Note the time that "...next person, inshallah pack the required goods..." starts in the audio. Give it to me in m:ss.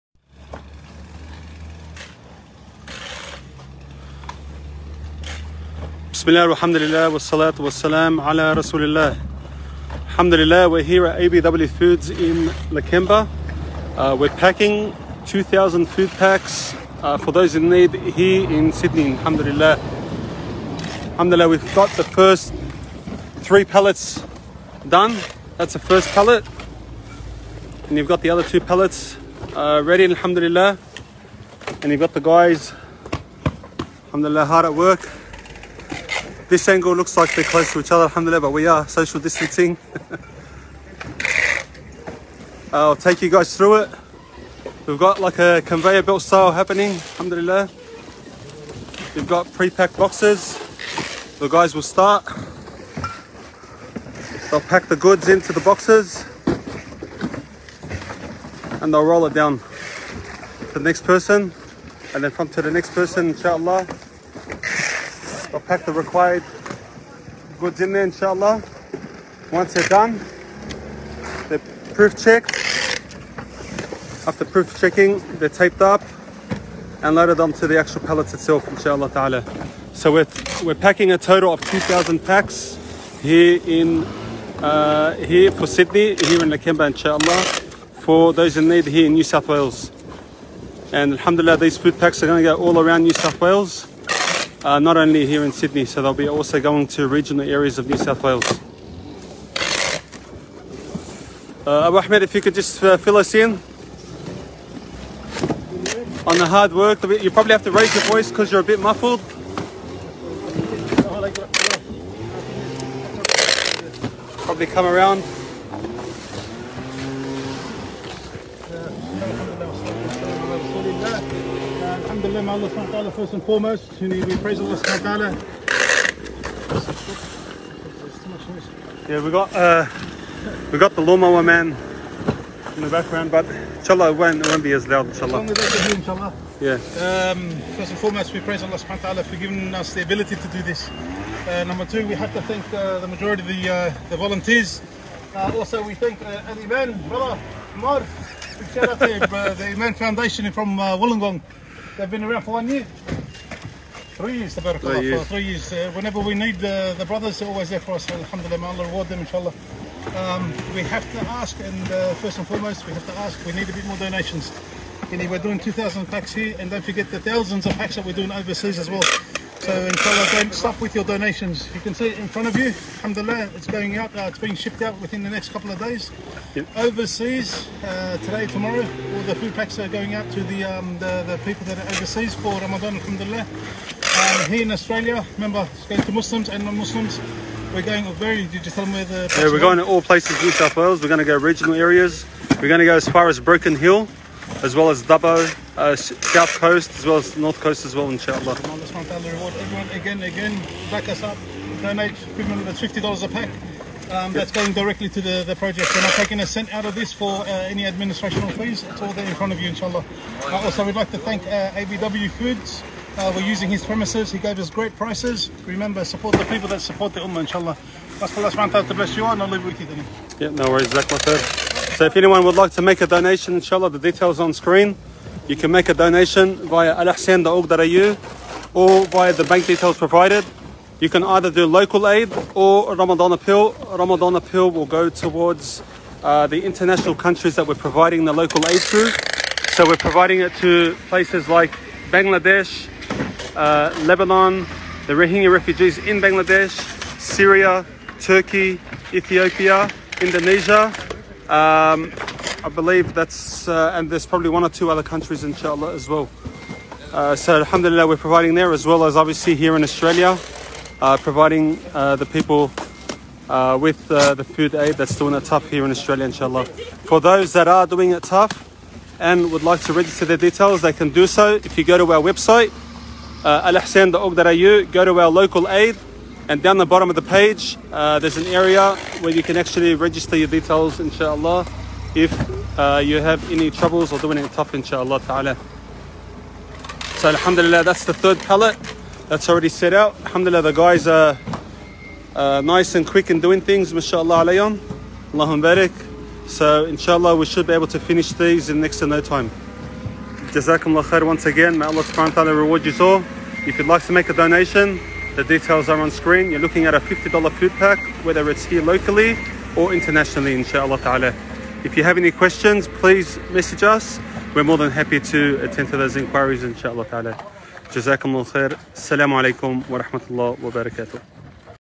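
1:02.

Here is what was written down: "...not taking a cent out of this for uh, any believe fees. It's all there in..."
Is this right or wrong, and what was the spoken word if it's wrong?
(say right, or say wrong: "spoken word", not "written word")
wrong: "administrative", not "believe".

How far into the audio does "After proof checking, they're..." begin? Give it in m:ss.
1:14.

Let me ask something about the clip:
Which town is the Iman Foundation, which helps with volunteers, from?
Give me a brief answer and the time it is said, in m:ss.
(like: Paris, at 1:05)
Wollongong, at 2:31.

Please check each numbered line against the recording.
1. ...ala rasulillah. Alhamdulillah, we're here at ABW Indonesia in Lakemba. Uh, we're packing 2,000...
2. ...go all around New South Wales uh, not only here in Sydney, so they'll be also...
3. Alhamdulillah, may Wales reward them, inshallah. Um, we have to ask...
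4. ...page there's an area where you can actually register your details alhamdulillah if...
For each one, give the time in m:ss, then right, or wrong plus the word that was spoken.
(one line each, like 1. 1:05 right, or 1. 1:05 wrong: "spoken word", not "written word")
1. 0:08 wrong: "Foods", not "Indonesia"
2. 1:32 right
3. 2:38 wrong: "Allah", not "Wales"
4. 4:37 wrong: "inshallah", not "alhamdulillah".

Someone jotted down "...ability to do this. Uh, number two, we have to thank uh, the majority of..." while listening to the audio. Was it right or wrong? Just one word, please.
right.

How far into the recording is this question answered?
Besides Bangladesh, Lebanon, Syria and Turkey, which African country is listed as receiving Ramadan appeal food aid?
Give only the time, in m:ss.
4:09.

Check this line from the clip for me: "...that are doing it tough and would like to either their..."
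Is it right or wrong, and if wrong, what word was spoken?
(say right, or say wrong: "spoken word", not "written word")
wrong: "register", not "either".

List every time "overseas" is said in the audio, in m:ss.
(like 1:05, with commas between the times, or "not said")
2:48, 2:56, 3:01.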